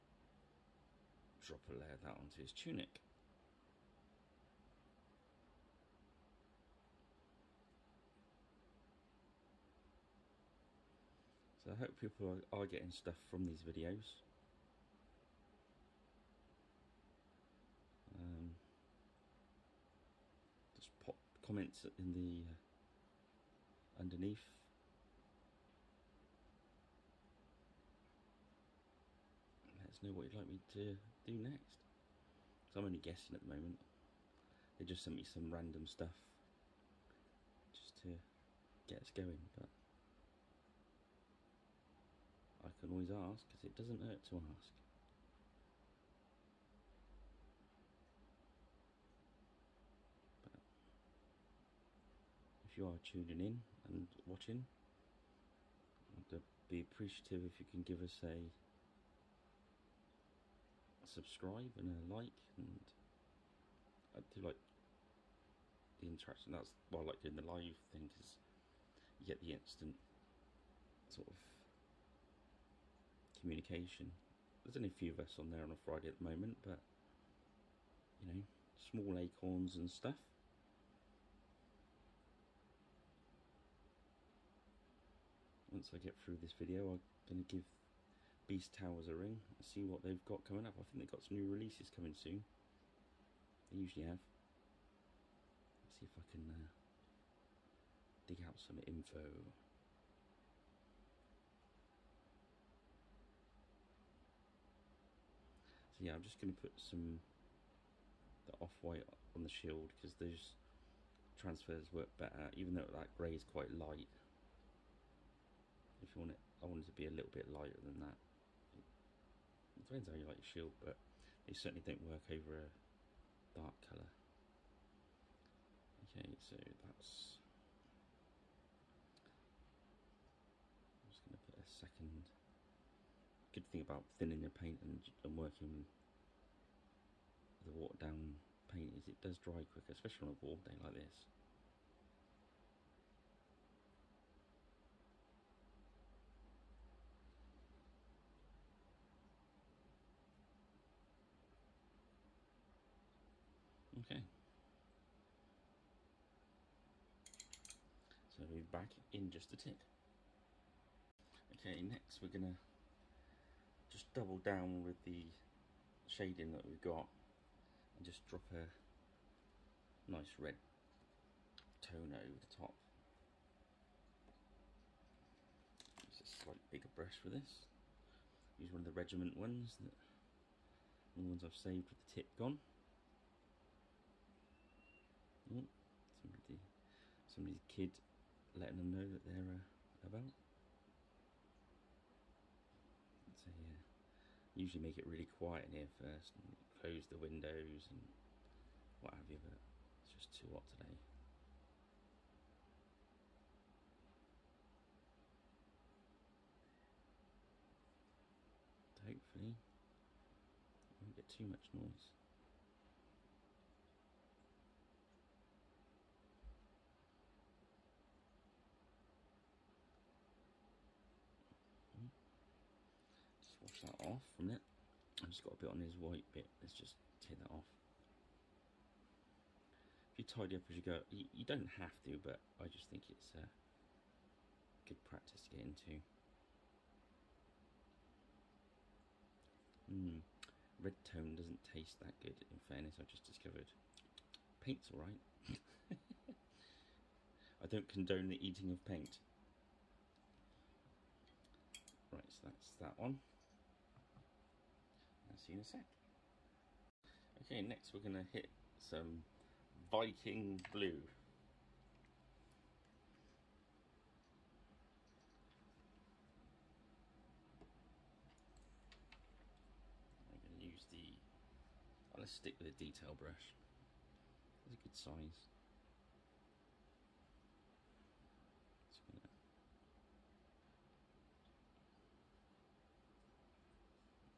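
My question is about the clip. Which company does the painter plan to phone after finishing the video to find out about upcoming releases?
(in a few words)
Beast Towers.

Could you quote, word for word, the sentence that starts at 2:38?
So we're back in just a tick.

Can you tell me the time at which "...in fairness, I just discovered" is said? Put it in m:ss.
4:02.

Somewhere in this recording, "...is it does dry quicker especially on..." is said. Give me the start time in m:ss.
2:18.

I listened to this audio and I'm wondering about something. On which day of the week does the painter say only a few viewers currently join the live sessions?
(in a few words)
Friday.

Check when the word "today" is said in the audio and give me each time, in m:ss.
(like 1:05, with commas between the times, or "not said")
3:20.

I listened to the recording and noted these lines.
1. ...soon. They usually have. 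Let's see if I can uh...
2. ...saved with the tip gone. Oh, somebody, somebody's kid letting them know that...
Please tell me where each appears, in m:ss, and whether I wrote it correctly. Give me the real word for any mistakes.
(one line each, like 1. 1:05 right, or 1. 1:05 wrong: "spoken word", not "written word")
1. 1:32 right
2. 3:01 right.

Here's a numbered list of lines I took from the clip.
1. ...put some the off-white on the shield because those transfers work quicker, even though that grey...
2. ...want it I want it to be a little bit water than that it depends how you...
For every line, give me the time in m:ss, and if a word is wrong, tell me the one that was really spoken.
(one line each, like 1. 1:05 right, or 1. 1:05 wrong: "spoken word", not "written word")
1. 1:46 wrong: "better", not "quicker"
2. 1:56 wrong: "lighter", not "water".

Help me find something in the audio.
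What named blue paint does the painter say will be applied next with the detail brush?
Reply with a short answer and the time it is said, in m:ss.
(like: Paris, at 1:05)
Viking Blue, at 4:19.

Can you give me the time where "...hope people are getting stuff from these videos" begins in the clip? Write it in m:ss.
0:11.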